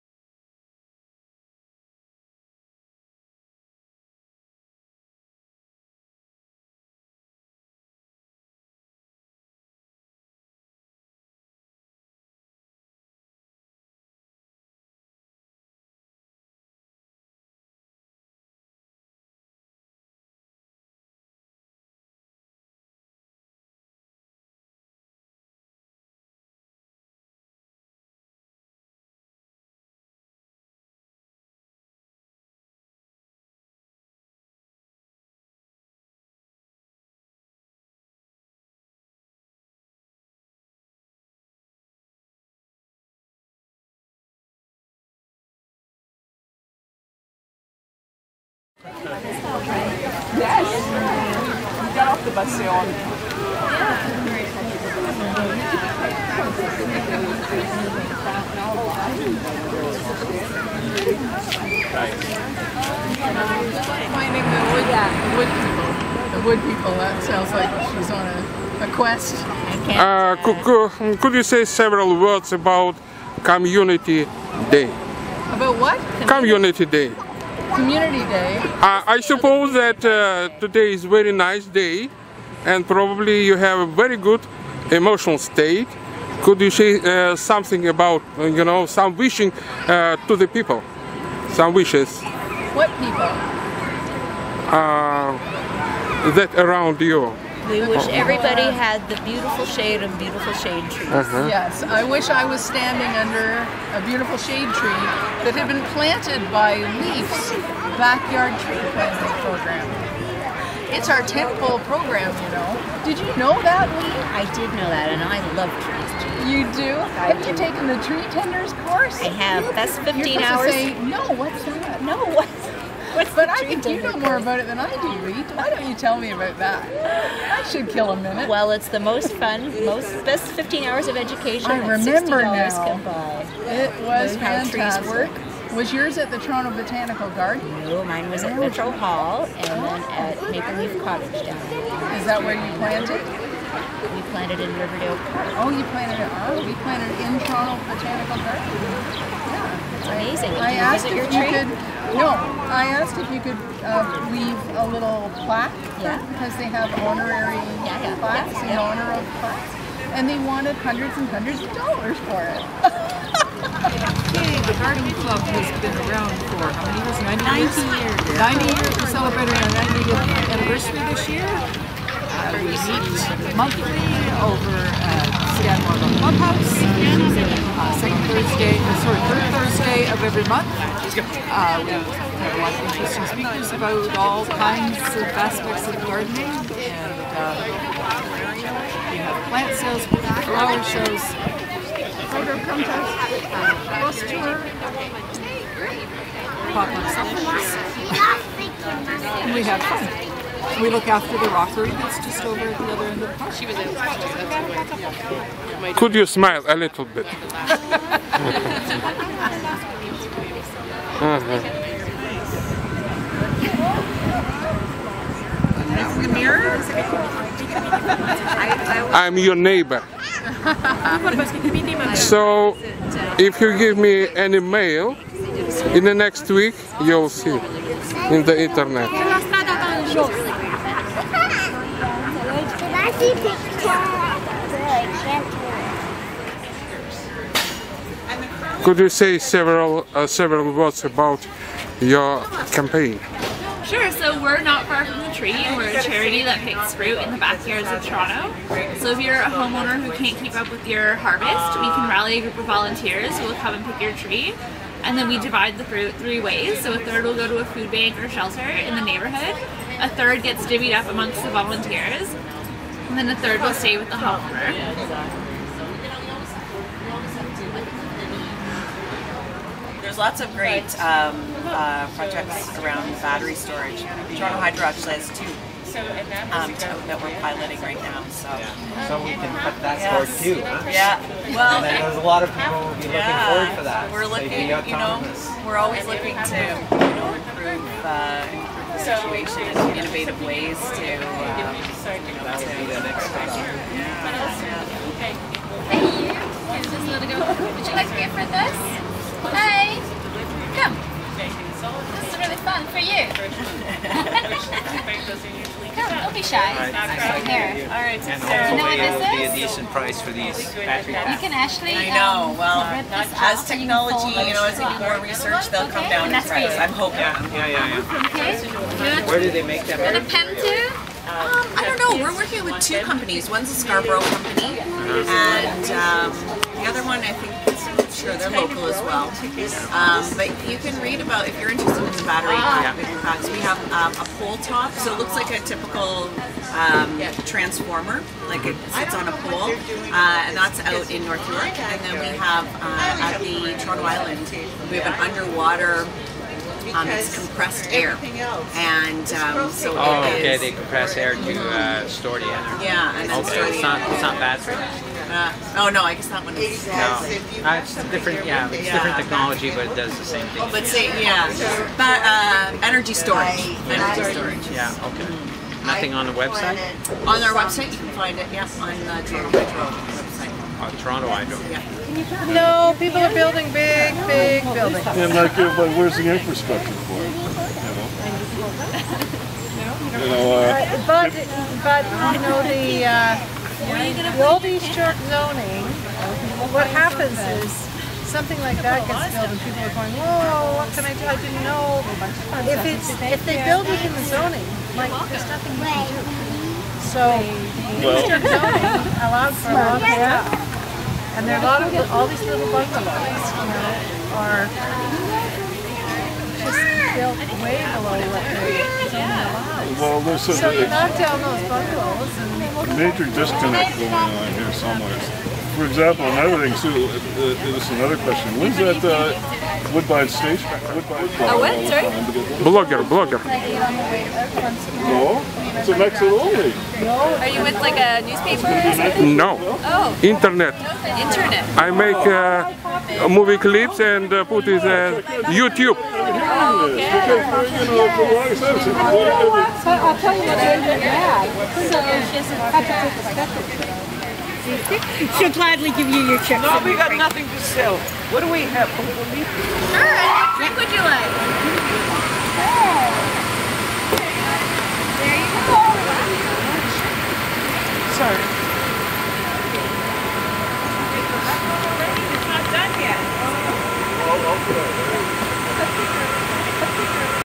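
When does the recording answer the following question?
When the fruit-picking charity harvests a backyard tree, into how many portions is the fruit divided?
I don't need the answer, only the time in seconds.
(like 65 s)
256 s.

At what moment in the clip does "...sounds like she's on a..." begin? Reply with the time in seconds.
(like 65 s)
67 s.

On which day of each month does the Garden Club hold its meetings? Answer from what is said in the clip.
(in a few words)
Third Thursday.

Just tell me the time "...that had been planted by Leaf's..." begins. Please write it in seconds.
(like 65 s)
105 s.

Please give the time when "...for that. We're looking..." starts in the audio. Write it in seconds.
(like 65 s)
283 s.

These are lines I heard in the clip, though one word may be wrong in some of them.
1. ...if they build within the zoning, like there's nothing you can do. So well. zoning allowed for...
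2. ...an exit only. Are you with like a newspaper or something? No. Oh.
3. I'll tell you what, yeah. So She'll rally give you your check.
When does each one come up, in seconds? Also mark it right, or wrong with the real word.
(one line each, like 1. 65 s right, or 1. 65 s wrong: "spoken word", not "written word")
1. 393 s right
2. 425 s right
3. 437 s wrong: "gladly", not "rally".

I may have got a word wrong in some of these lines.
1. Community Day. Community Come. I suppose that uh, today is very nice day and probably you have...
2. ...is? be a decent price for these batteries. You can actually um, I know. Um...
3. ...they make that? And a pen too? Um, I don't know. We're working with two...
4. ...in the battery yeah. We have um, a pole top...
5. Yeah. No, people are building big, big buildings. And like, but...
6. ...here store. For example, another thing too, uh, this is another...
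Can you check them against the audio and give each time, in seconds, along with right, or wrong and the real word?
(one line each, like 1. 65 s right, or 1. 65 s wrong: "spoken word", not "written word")
1. 76 s wrong: "Day", not "Come"
2. 309 s right
3. 319 s right
4. 331 s right
5. 371 s right
6. 414 s wrong: "somewhere", not "store".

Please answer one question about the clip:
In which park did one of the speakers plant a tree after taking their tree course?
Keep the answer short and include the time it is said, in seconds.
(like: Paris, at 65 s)
Riverdale Park, at 144 s.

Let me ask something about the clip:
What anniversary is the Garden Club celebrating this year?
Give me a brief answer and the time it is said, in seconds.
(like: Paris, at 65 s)
90th, at 169 s.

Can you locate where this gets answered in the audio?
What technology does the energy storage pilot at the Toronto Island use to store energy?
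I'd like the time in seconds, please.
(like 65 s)
347 s.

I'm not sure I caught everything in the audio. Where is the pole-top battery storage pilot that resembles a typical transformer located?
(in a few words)
North York.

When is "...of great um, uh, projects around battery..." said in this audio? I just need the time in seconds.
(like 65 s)
270 s.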